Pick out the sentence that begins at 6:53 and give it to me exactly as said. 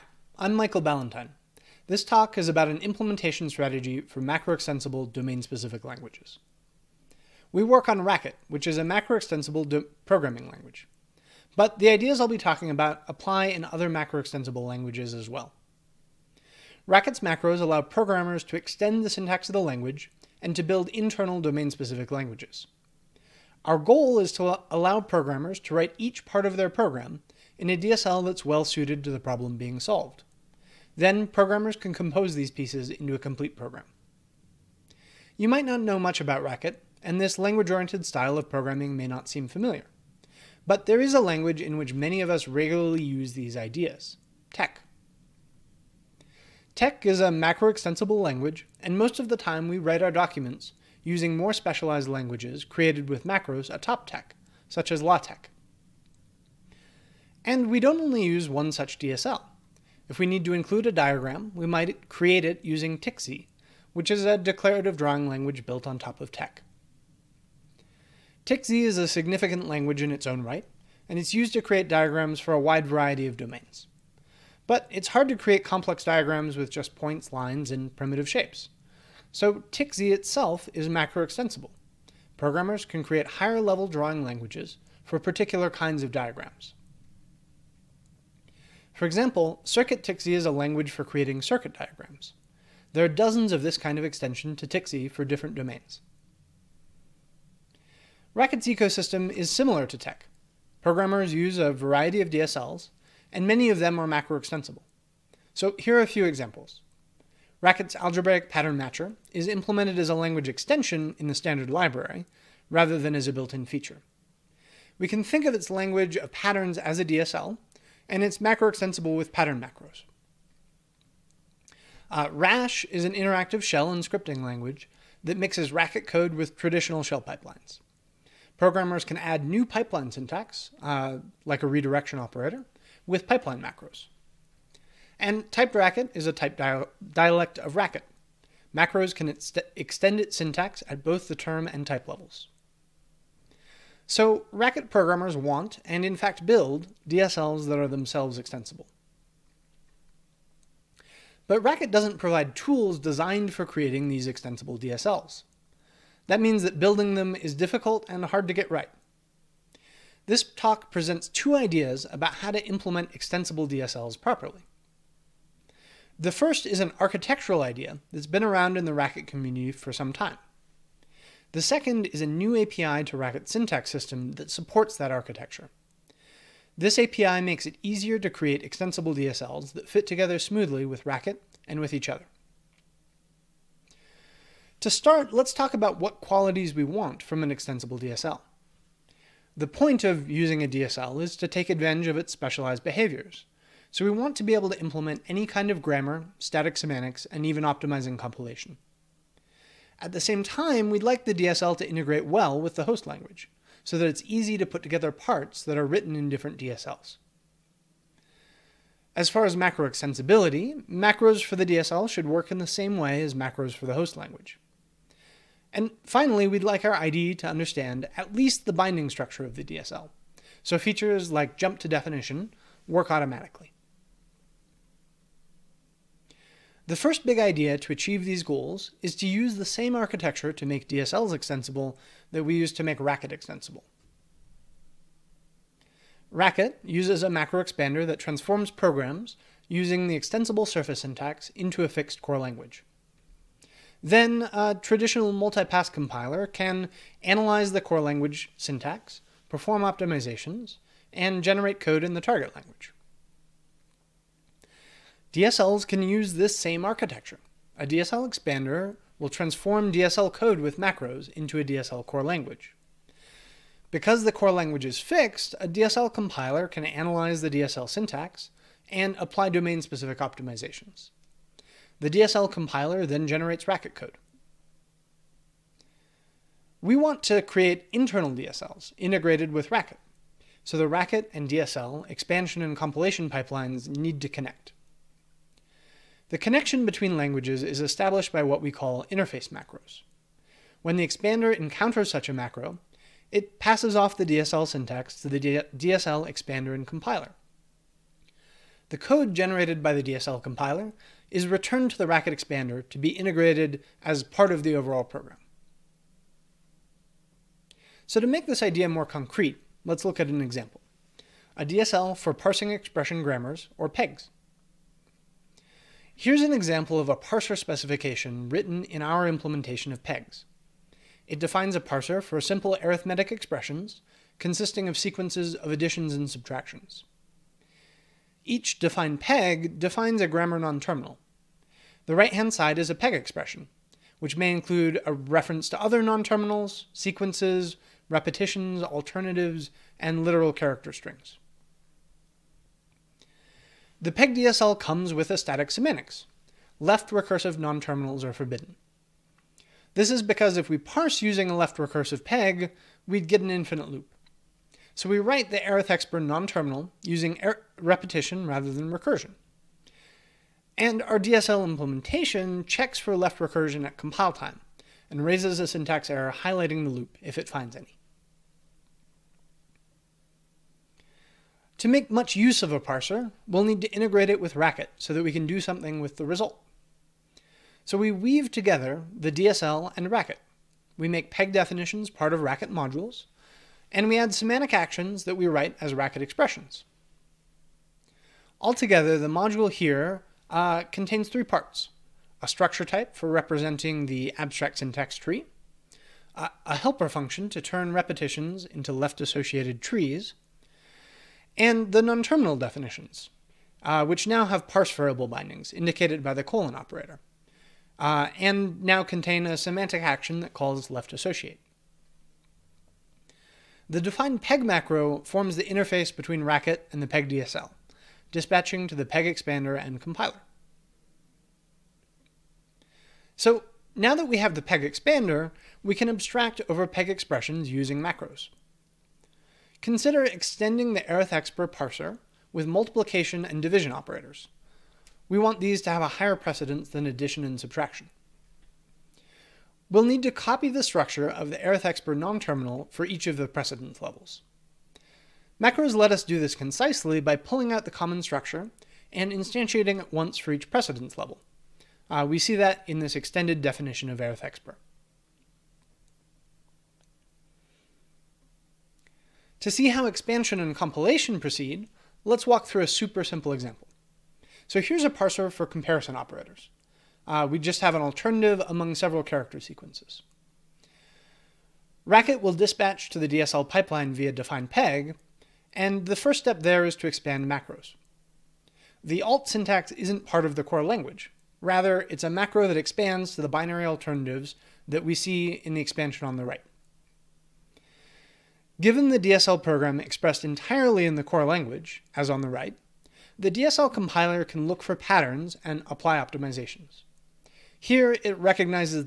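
The defined peg macro forms the interface between Racket and the peg DSL, dispatching to the peg expander and compiler.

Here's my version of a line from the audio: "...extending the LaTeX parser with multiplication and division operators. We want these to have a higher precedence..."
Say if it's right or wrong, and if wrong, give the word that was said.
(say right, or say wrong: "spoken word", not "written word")
wrong: "Arith", not "LaTeX".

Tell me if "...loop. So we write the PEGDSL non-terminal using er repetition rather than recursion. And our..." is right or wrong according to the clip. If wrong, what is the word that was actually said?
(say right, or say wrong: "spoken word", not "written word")
wrong: "Arith", not "PEGDSL".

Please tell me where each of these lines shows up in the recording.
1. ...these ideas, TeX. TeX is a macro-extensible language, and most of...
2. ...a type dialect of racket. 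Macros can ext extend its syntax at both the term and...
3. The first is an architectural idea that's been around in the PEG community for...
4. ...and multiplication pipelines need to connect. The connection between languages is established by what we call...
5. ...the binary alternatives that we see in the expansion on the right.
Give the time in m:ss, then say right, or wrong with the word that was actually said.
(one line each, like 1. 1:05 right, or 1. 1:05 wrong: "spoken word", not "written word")
1. 0:43 right
2. 2:16 right
3. 2:46 wrong: "Racket", not "PEG"
4. 4:42 wrong: "compilation", not "multiplication"
5. 8:03 right.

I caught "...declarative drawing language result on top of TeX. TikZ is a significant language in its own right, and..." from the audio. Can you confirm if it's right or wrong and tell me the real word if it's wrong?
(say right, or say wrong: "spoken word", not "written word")
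wrong: "built", not "result".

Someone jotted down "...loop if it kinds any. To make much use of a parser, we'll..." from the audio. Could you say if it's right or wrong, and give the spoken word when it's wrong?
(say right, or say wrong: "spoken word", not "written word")
wrong: "finds", not "kinds".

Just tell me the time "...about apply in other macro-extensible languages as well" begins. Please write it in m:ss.
0:12.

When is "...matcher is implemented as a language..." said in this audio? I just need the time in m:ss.
1:48.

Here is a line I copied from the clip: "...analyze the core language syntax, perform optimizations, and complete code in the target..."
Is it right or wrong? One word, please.
wrong.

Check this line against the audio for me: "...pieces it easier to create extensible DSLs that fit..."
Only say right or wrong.
wrong.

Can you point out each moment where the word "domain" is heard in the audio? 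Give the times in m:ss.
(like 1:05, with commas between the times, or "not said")
0:05, 0:21, 1:13, 1:35, 4:29.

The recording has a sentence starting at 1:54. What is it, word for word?
We can think of its language of patterns as a DSL, and it's macro extensible with pattern macros.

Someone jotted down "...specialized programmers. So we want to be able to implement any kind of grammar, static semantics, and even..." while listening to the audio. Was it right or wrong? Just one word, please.
wrong.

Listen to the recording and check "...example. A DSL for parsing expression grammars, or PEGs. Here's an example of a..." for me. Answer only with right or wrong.
right.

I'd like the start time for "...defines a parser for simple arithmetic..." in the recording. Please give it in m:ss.
5:21.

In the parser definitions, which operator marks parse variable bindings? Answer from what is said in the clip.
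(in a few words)
the colon operator.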